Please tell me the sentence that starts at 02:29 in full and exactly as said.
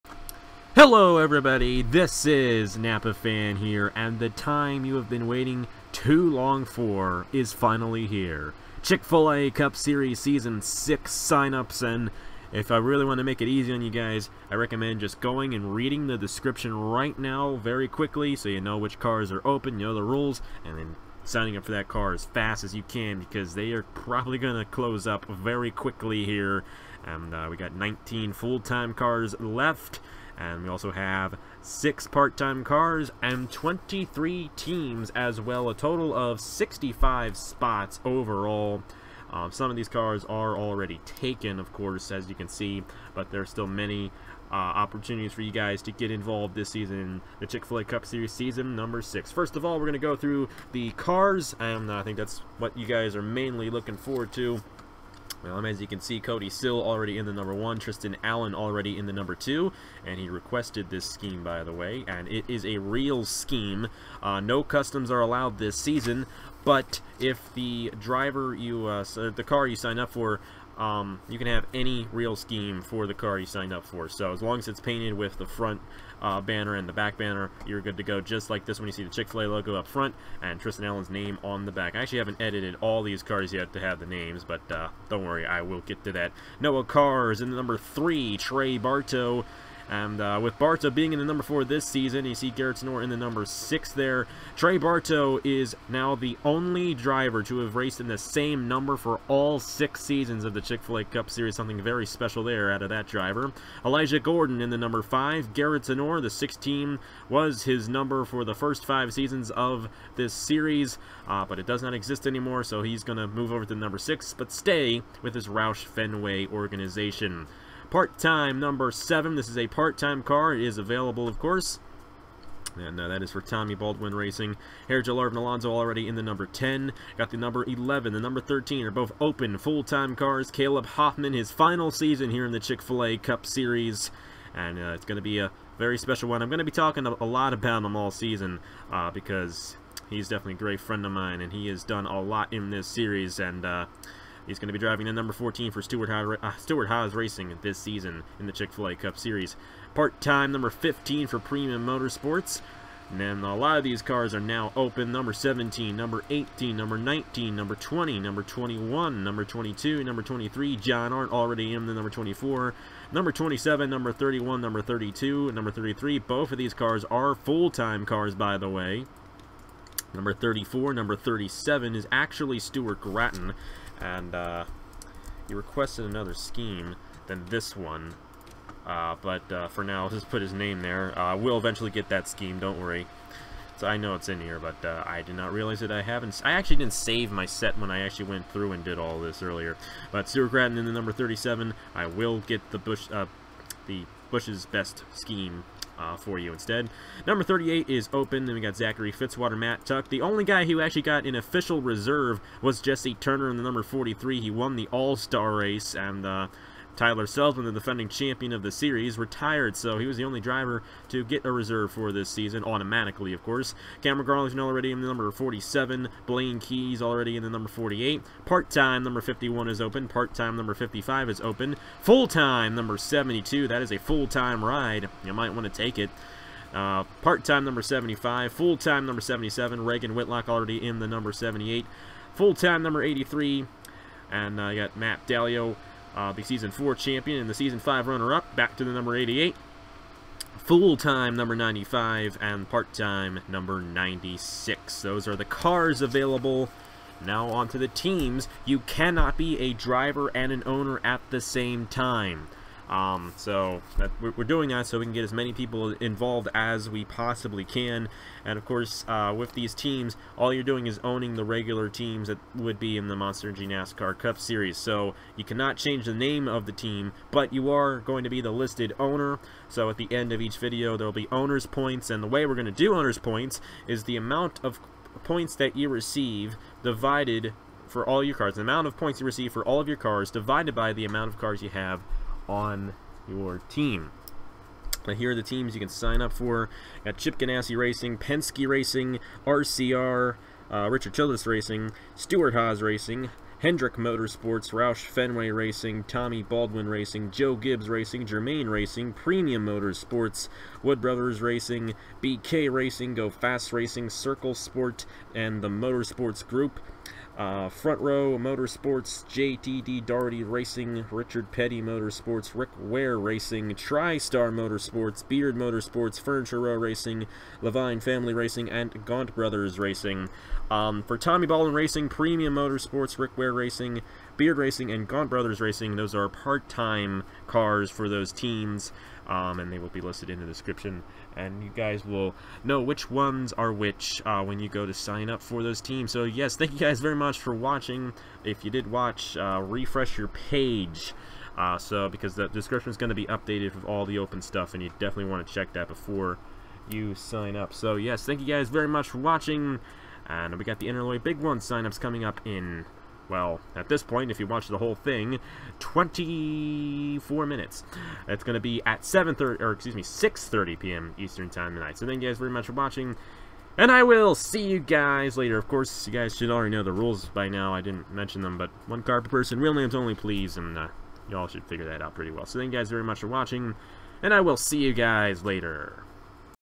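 Part-time number 15 for Premium Motorsports.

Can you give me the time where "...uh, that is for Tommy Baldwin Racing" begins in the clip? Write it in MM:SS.
02:02.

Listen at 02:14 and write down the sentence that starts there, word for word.
And uh, it's going to be a very special one.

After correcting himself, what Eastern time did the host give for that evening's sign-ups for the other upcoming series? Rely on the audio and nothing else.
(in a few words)
6:30 p.m.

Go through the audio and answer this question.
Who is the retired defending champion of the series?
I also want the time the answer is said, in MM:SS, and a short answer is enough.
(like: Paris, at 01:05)
Tyler Selzman, at 03:26.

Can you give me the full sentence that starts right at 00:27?
And uh, we got 19 full-time cars left.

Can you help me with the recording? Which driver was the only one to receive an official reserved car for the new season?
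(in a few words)
Jesse Turner.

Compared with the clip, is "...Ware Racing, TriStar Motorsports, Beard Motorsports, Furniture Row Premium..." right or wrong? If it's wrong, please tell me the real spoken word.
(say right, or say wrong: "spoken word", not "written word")
wrong: "Racing", not "Premium".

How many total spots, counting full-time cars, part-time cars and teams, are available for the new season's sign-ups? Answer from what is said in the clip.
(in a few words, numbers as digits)
65.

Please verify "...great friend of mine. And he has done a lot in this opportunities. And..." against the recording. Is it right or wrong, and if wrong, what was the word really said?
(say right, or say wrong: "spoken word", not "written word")
wrong: "series", not "opportunities".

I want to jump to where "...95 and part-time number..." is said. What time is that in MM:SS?
04:01.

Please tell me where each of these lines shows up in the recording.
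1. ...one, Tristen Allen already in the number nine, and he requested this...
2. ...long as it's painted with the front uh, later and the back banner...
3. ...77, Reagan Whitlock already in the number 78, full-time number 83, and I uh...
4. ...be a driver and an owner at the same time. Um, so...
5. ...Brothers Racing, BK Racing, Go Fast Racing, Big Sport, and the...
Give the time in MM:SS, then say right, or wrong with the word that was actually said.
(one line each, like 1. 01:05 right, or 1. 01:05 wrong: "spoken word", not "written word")
1. 00:57 wrong: "two", not "nine"
2. 01:14 wrong: "banner", not "later"
3. 03:49 right
4. 04:09 right
5. 05:01 wrong: "Circle", not "Big".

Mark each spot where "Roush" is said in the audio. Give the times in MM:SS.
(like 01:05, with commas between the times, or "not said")
01:55, 04:54.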